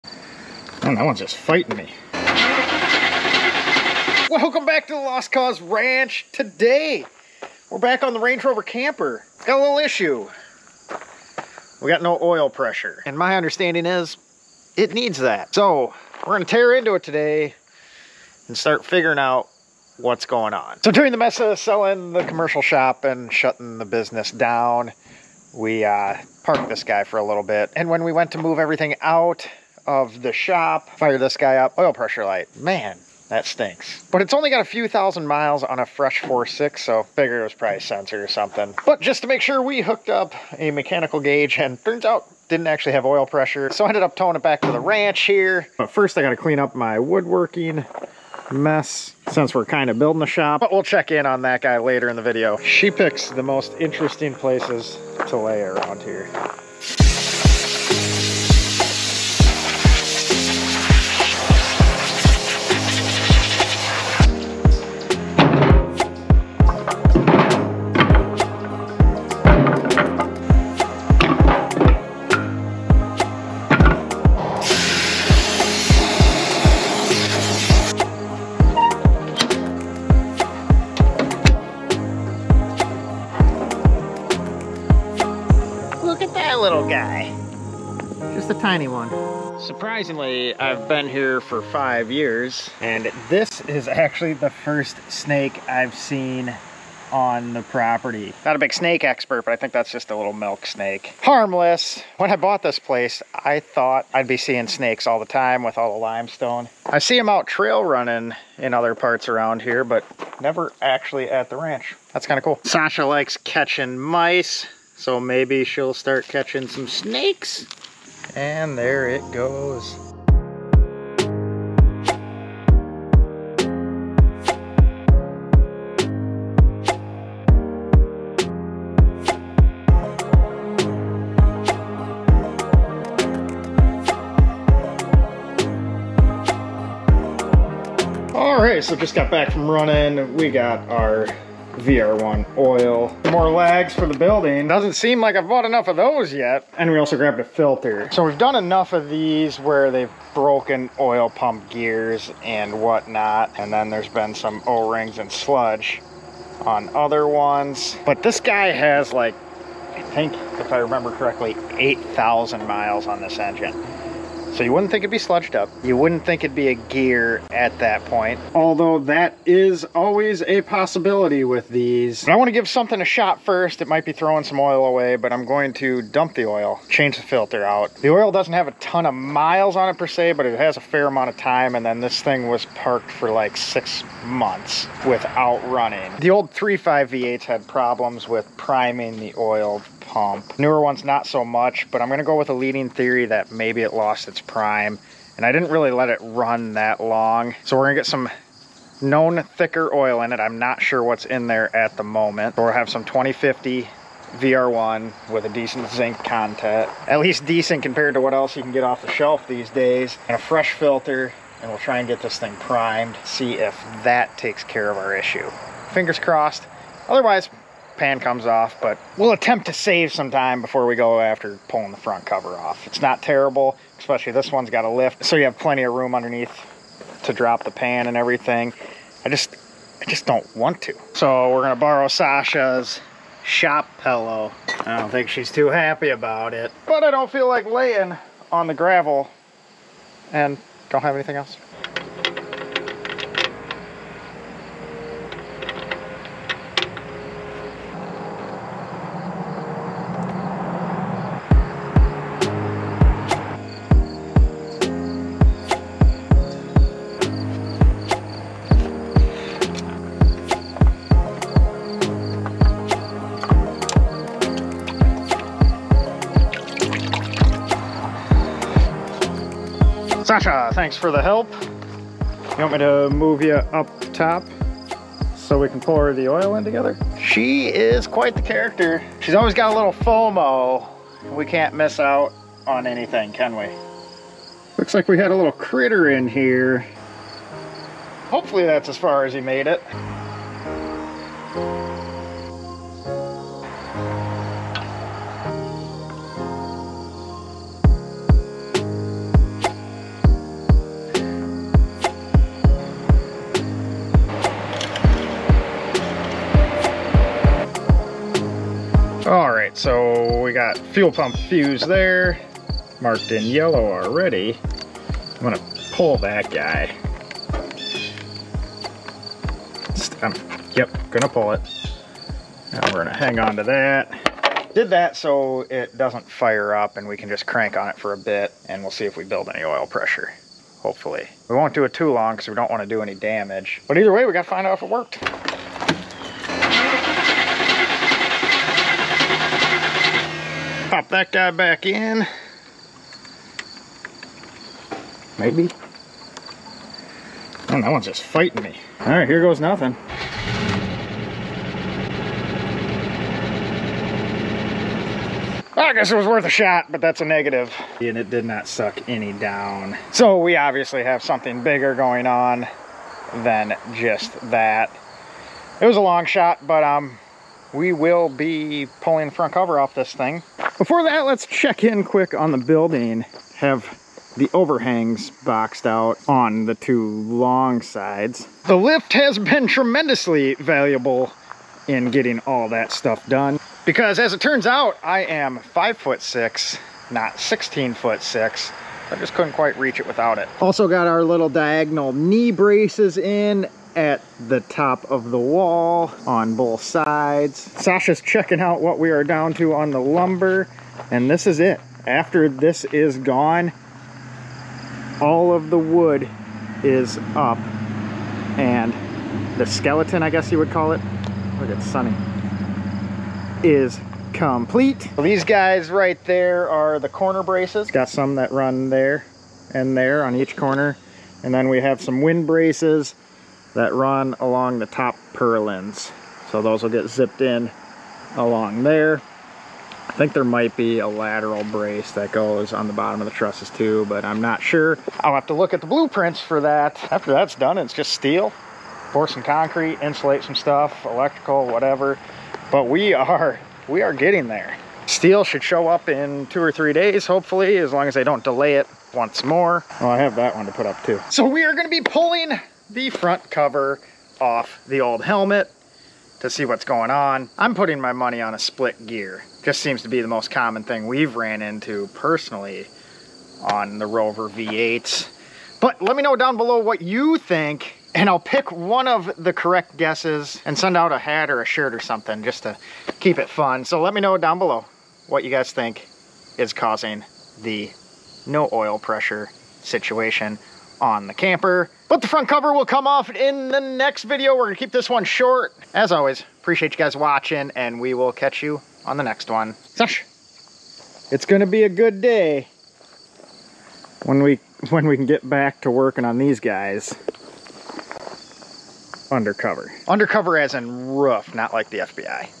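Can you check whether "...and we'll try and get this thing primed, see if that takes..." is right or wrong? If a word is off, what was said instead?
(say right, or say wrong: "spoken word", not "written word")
right.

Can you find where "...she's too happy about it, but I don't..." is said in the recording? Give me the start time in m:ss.
3:55.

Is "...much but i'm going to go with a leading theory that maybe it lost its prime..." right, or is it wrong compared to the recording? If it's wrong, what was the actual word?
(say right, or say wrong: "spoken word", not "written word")
right.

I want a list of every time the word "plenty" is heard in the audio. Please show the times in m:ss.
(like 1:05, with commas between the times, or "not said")
3:45.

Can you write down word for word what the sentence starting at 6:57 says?
got some that run there and there on each corner.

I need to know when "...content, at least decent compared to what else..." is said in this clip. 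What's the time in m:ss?
3:26.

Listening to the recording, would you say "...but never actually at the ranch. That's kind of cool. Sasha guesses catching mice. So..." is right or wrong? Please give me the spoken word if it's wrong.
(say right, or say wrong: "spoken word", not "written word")
wrong: "likes", not "guesses".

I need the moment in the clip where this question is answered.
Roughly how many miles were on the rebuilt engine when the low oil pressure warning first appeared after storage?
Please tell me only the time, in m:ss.
0:34.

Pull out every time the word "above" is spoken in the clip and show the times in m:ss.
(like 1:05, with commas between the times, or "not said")
not said.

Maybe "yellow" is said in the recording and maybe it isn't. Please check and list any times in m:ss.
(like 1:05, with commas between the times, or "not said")
5:13.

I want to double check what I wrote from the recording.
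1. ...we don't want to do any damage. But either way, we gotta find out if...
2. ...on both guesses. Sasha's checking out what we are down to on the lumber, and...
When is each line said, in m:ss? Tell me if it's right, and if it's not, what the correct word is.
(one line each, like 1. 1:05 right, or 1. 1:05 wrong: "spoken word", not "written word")
1. 5:32 right
2. 6:36 wrong: "sides", not "guesses".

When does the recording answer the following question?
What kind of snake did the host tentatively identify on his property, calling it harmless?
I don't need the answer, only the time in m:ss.
1:40.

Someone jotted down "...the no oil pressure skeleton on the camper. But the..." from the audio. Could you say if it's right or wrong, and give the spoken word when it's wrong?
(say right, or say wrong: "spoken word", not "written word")
wrong: "situation", not "skeleton".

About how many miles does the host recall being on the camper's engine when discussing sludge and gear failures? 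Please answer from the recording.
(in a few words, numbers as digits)
8,000.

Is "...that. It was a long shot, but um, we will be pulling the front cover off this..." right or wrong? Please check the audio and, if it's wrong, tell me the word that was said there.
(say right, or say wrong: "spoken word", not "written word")
right.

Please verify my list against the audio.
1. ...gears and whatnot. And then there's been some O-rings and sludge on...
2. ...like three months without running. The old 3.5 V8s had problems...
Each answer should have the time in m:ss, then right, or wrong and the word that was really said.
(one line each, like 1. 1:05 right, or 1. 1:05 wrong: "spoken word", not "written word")
1. 2:31 right
2. 3:03 wrong: "six", not "three".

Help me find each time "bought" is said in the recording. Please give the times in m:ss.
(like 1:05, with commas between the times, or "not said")
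1:42, 2:25.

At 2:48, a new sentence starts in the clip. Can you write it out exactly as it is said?
Although that is always a possibility with these.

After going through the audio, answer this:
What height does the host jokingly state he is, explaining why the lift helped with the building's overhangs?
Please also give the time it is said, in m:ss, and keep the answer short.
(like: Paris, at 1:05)
5 foot 6, at 6:25.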